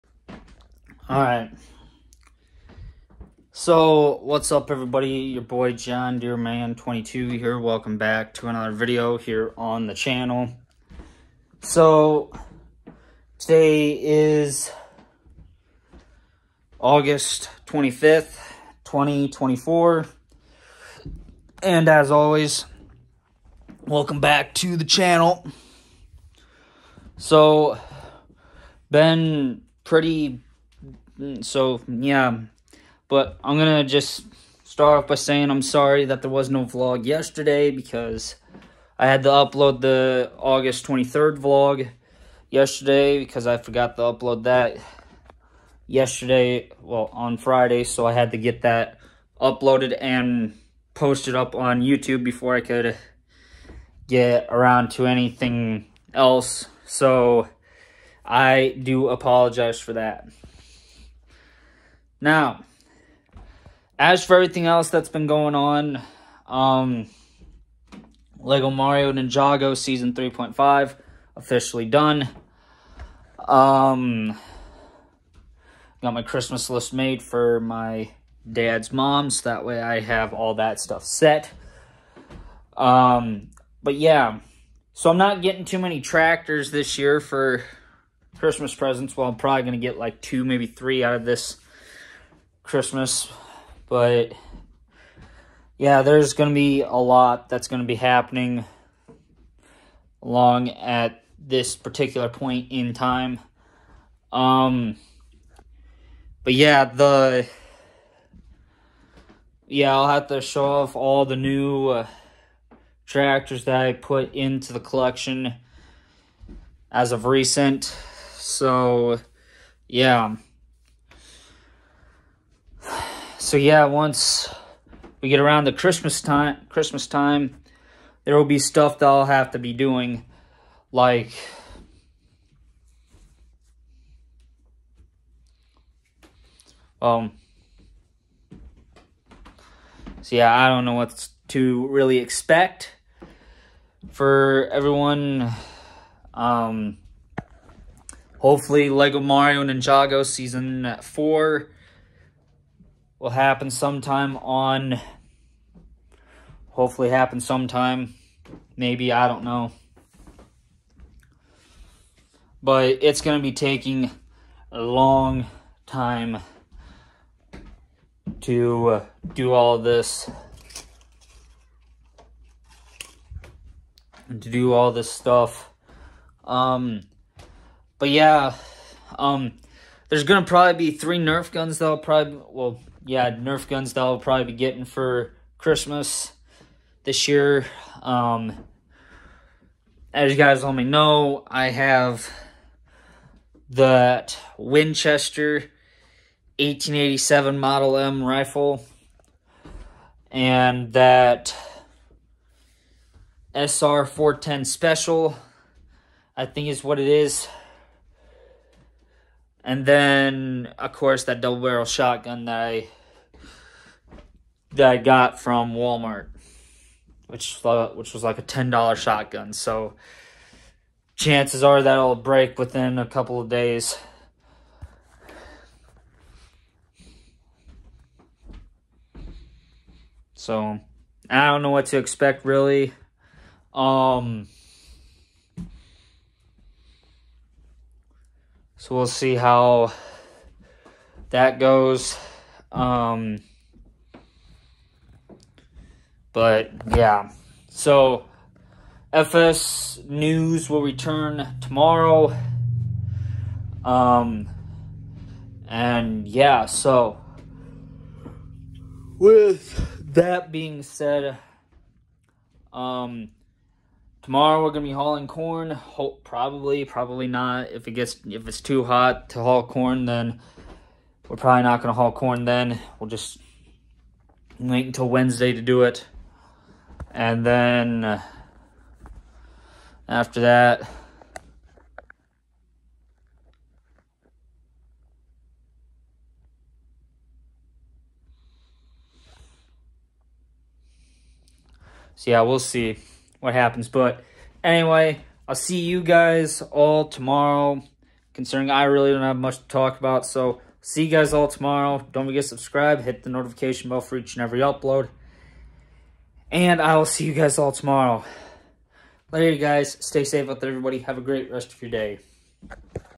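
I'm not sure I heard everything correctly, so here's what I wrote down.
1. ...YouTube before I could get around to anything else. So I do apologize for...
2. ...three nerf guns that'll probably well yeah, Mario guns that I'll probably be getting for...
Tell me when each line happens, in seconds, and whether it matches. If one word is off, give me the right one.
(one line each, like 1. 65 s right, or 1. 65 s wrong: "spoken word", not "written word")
1. 51 s right
2. 180 s wrong: "Nerf", not "Mario".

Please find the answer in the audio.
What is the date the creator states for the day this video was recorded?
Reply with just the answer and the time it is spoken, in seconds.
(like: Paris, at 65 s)
August 25th, 2024, at 16 s.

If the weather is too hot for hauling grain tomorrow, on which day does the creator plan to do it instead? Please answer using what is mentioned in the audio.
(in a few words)
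Wednesday.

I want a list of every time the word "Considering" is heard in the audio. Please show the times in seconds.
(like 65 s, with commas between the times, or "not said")
298 s.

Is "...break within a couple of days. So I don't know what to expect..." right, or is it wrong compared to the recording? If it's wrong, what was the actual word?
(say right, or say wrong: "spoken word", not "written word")
right.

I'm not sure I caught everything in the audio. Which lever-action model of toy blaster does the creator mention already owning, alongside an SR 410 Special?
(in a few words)
Winchester 1887.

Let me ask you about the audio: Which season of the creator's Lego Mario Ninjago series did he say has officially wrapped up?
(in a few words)
Season 3.5.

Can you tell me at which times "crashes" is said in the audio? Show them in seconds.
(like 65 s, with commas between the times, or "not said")
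not said.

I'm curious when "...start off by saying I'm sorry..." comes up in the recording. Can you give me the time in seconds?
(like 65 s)
34 s.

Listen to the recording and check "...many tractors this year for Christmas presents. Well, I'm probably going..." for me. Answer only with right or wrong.
right.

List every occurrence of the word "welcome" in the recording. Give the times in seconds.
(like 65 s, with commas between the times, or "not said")
7 s, 23 s.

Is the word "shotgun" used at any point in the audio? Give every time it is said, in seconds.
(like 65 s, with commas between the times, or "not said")
211 s, 218 s.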